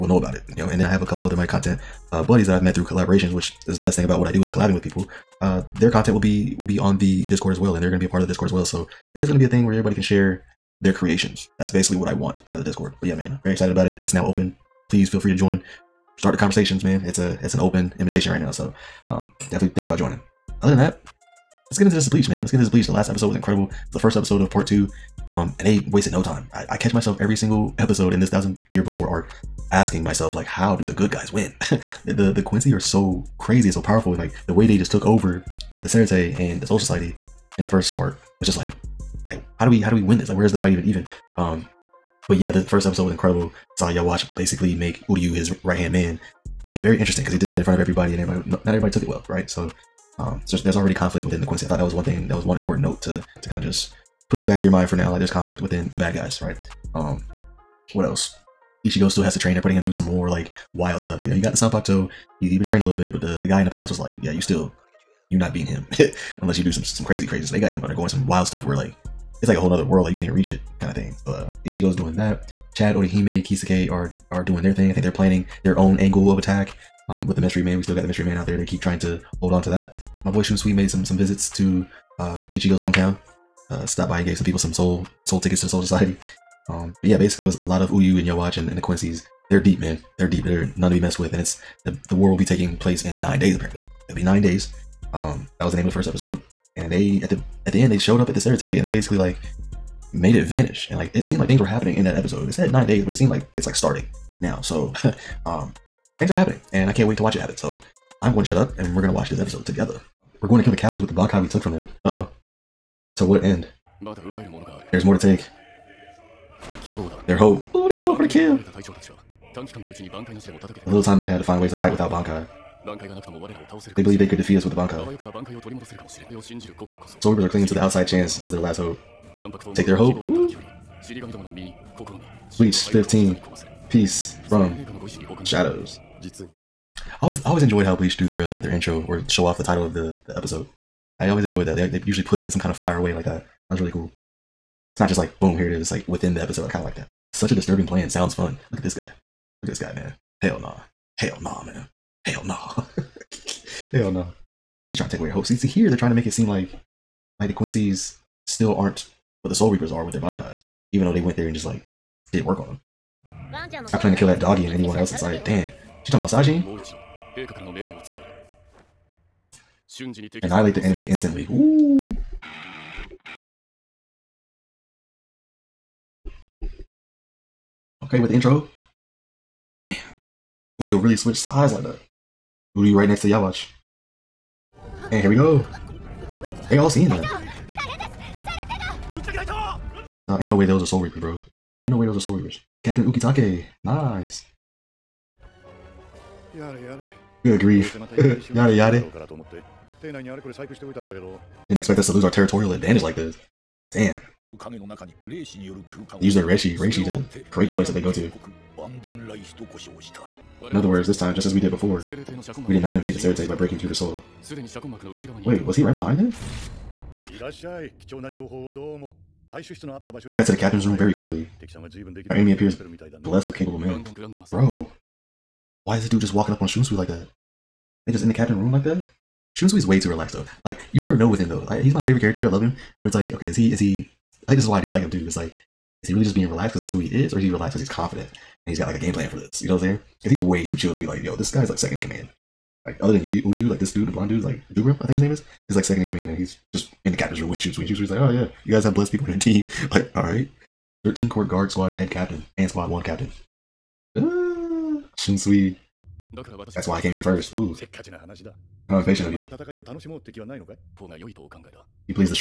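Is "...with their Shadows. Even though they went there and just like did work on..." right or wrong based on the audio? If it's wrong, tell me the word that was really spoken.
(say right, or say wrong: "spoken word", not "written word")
wrong: "Bankais", not "Shadows".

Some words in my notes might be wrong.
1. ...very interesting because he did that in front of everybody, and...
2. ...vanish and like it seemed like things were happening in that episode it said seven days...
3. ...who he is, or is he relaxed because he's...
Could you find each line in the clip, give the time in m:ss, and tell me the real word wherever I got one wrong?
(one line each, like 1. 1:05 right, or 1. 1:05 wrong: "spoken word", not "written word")
1. 0:46 right
2. 1:40 wrong: "nine", not "seven"
3. 3:56 right.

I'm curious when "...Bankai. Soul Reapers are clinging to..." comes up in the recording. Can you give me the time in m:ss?
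2:04.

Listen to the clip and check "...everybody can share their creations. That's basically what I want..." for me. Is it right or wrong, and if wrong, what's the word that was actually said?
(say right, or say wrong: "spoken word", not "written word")
right.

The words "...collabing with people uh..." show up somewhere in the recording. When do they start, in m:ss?
0:04.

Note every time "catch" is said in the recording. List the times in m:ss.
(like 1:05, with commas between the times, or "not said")
0:26.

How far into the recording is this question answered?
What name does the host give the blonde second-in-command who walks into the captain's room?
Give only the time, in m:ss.
4:04.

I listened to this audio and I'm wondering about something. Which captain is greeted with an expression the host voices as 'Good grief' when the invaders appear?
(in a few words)
Captain Ukitake.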